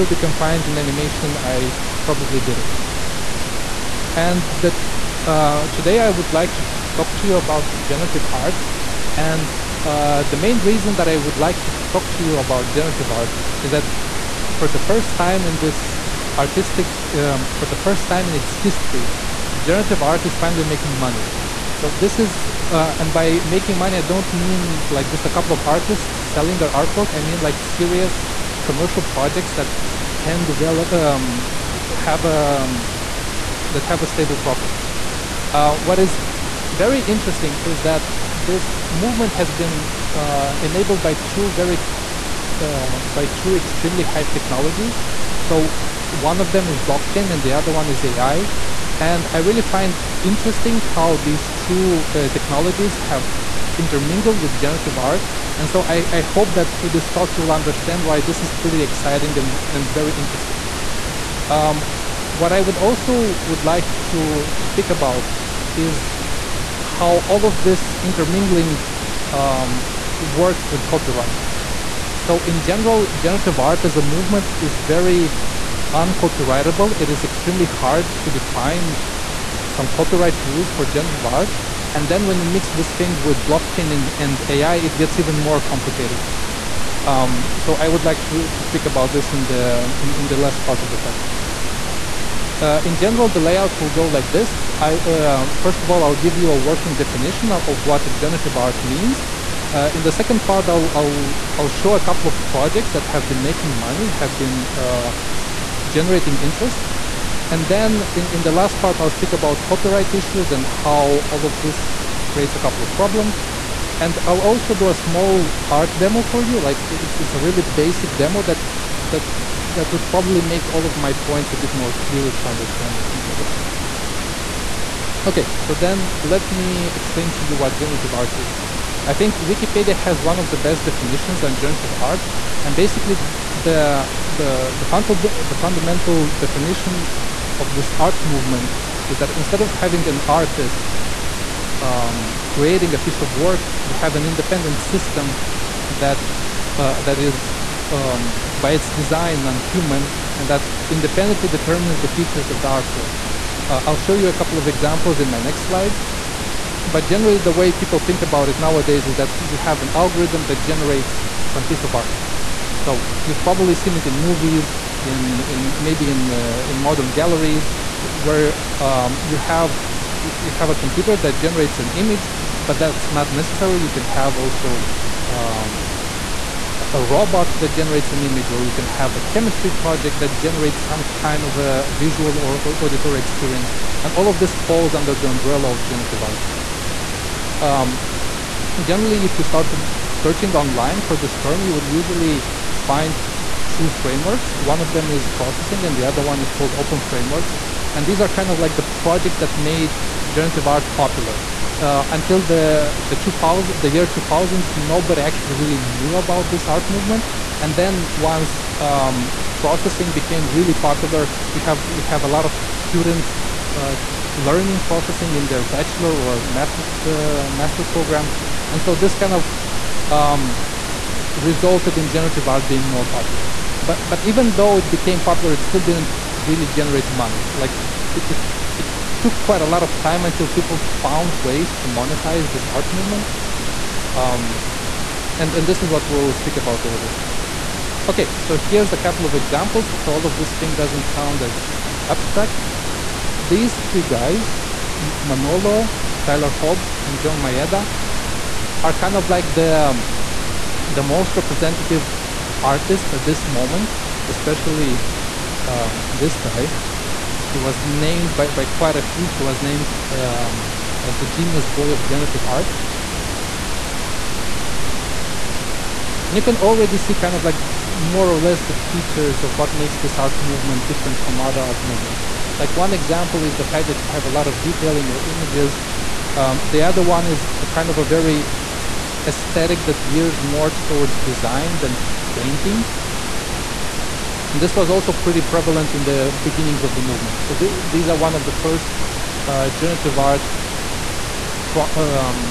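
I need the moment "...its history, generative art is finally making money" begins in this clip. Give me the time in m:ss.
0:18.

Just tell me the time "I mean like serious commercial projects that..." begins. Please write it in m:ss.
0:27.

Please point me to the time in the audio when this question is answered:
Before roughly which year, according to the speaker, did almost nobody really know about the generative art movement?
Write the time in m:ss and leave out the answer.
3:23.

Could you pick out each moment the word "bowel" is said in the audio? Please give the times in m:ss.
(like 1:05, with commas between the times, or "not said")
not said.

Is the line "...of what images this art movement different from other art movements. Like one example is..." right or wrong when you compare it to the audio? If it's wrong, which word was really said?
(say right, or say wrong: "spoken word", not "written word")
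wrong: "makes", not "images".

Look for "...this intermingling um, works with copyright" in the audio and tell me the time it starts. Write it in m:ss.
1:07.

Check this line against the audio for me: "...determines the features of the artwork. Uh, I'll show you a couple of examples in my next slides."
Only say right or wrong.
right.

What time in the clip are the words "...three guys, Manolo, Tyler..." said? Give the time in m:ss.
4:03.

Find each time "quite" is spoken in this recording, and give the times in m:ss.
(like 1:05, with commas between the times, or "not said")
3:49, 4:18.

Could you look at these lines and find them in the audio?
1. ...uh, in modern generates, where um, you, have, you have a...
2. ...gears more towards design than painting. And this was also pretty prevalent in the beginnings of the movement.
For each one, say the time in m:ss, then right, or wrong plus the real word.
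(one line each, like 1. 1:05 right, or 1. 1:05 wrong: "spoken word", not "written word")
1. 2:46 wrong: "galleries", not "generates"
2. 4:40 right.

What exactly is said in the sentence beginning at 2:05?
Okay, so then let me explain to you what generative art is.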